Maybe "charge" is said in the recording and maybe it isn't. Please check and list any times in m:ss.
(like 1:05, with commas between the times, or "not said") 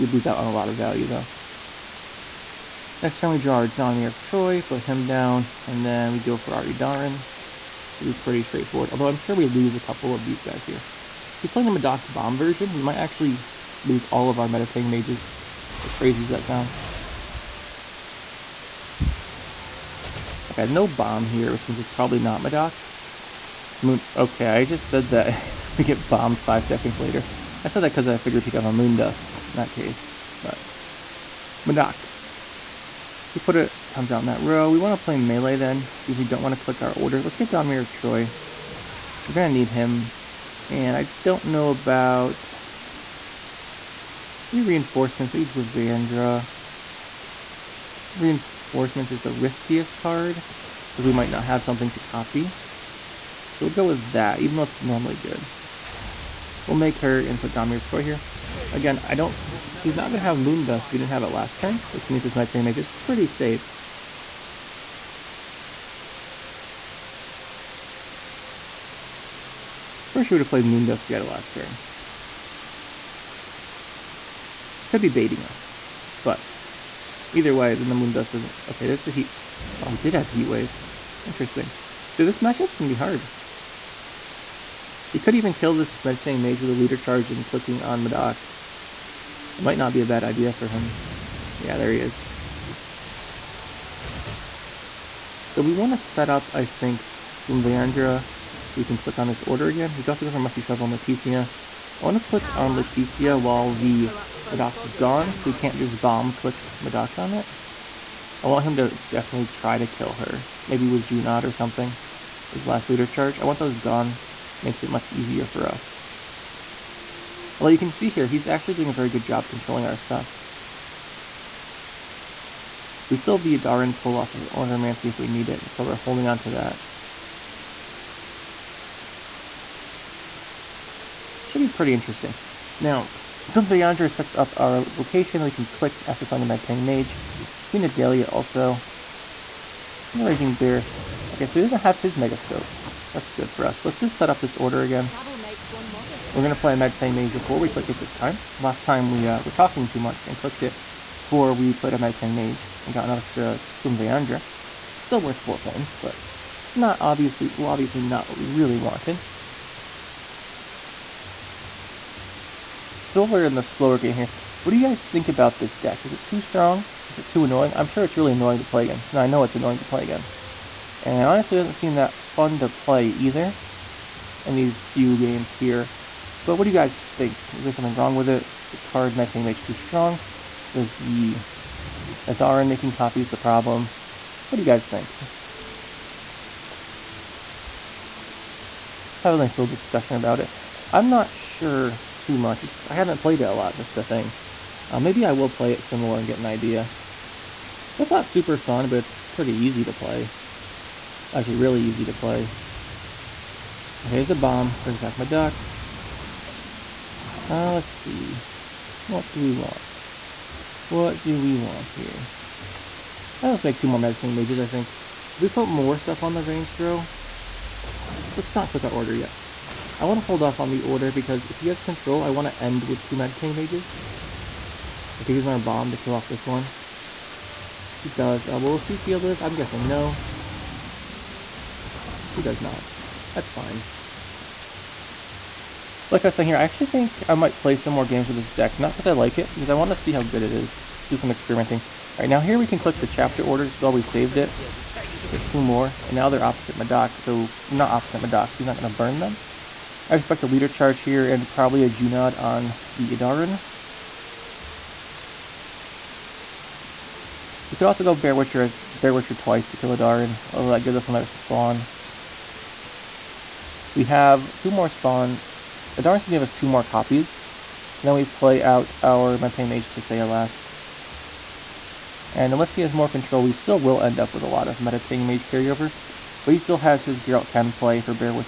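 1:26, 1:53, 4:10.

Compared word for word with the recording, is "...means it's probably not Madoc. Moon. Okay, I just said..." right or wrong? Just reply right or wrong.
right.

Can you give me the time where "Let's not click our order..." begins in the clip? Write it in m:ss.
3:38.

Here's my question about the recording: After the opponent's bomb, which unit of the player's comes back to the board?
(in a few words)
duck.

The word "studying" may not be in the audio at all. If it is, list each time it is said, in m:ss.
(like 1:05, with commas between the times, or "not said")
not said.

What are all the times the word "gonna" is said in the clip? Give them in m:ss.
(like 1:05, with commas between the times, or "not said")
0:39, 4:26.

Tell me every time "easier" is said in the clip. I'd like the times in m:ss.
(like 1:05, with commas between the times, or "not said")
1:55.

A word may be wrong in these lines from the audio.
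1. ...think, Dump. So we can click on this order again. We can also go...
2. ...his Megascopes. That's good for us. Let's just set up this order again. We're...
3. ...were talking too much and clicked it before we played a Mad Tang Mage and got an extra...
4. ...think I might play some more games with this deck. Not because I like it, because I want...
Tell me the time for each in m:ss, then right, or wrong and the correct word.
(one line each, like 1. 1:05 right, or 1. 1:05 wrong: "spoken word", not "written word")
1. 1:36 wrong: "Dwimveandra", not "Dump"
2. 2:21 right
3. 2:29 right
4. 3:56 right.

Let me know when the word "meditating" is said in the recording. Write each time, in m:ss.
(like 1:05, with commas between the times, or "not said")
1:26, 3:33, 3:43.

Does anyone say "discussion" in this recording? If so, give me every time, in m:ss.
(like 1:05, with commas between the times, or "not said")
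3:09.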